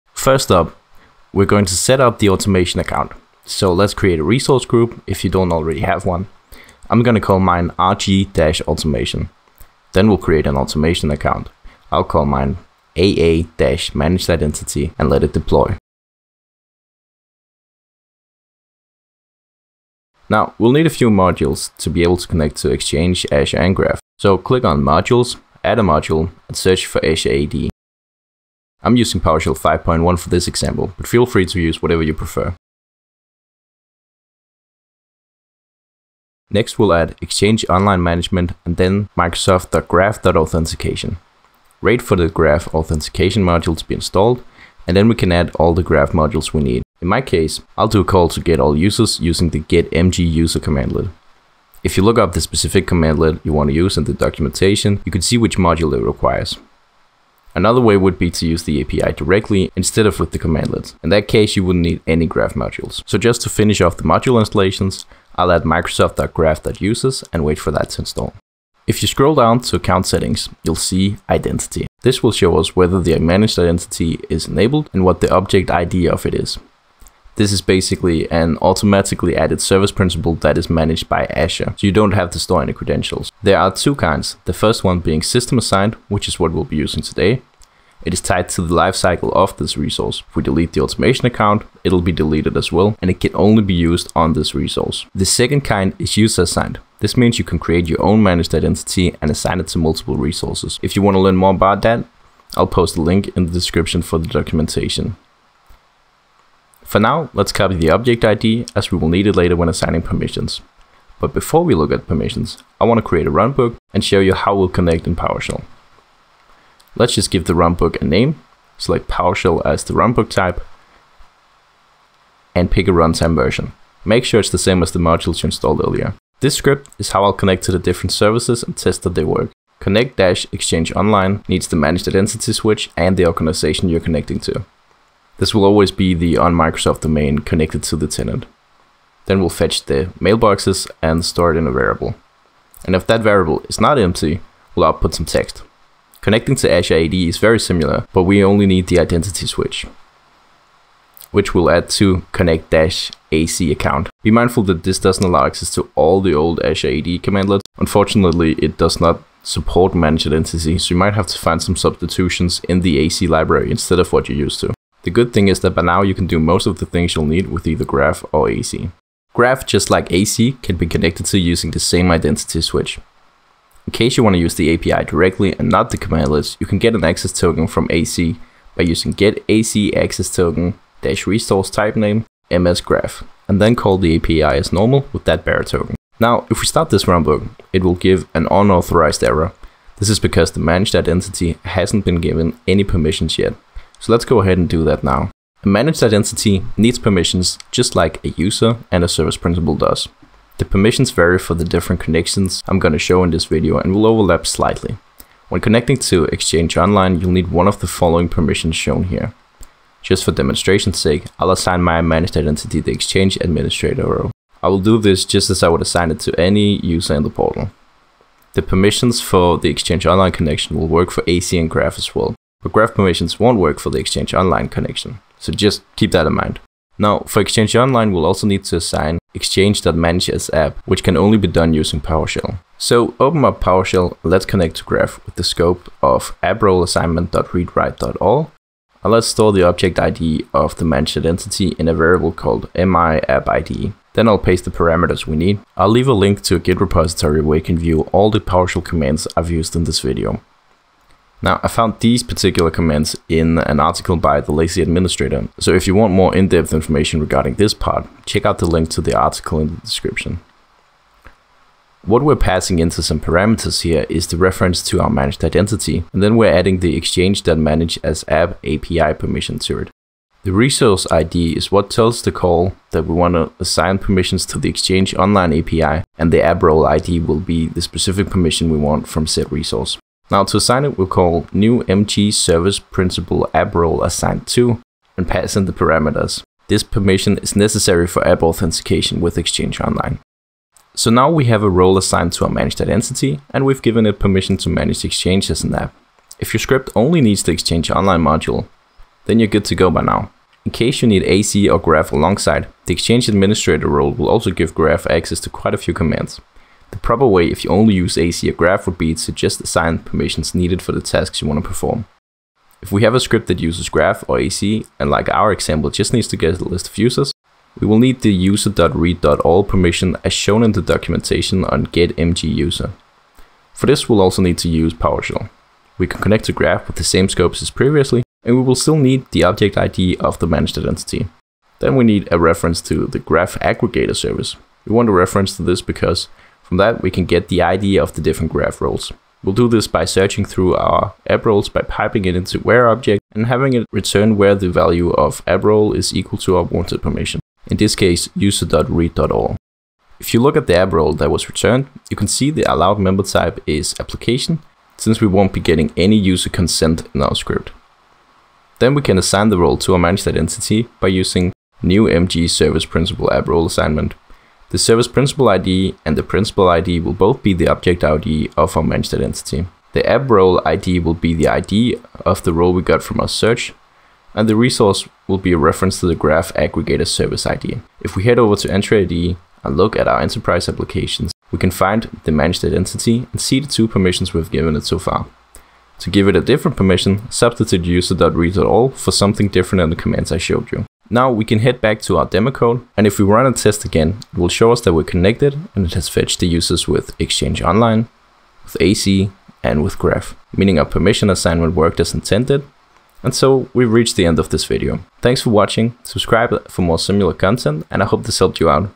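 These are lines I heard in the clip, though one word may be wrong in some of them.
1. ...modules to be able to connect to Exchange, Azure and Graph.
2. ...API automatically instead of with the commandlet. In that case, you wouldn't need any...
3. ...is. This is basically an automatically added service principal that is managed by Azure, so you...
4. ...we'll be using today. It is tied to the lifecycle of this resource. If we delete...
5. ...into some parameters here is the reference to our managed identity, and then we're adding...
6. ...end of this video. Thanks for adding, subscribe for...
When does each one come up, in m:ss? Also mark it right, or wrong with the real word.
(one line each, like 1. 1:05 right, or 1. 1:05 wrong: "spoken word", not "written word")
1. 0:21 right
2. 0:58 wrong: "directly", not "automatically"
3. 1:16 right
4. 1:26 right
5. 4:22 right
6. 6:44 wrong: "watching", not "adding".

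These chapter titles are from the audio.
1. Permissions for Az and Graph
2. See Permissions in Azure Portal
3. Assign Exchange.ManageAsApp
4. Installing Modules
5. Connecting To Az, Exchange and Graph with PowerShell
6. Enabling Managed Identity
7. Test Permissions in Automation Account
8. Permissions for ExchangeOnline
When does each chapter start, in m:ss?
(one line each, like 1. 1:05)
1. 5:10
2. 6:18
3. 3:46
4. 0:21
5. 1:52
6. 1:09
7. 6:31
8. 3:15.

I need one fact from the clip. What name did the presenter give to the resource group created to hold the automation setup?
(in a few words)
RG-automation.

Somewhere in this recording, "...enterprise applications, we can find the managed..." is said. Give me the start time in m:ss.
6:20.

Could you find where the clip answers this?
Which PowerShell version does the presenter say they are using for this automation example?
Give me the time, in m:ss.
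0:29.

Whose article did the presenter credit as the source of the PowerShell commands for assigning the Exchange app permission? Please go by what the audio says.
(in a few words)
the Lazy Administrator.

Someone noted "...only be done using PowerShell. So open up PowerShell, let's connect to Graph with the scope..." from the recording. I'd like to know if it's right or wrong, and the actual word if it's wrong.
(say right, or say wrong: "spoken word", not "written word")
right.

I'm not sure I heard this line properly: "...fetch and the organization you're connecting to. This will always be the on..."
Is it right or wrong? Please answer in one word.
wrong.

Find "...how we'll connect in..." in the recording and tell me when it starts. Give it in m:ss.
1:54.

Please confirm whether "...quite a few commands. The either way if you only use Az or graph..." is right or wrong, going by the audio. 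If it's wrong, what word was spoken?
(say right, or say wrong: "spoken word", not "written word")
wrong: "proper", not "either".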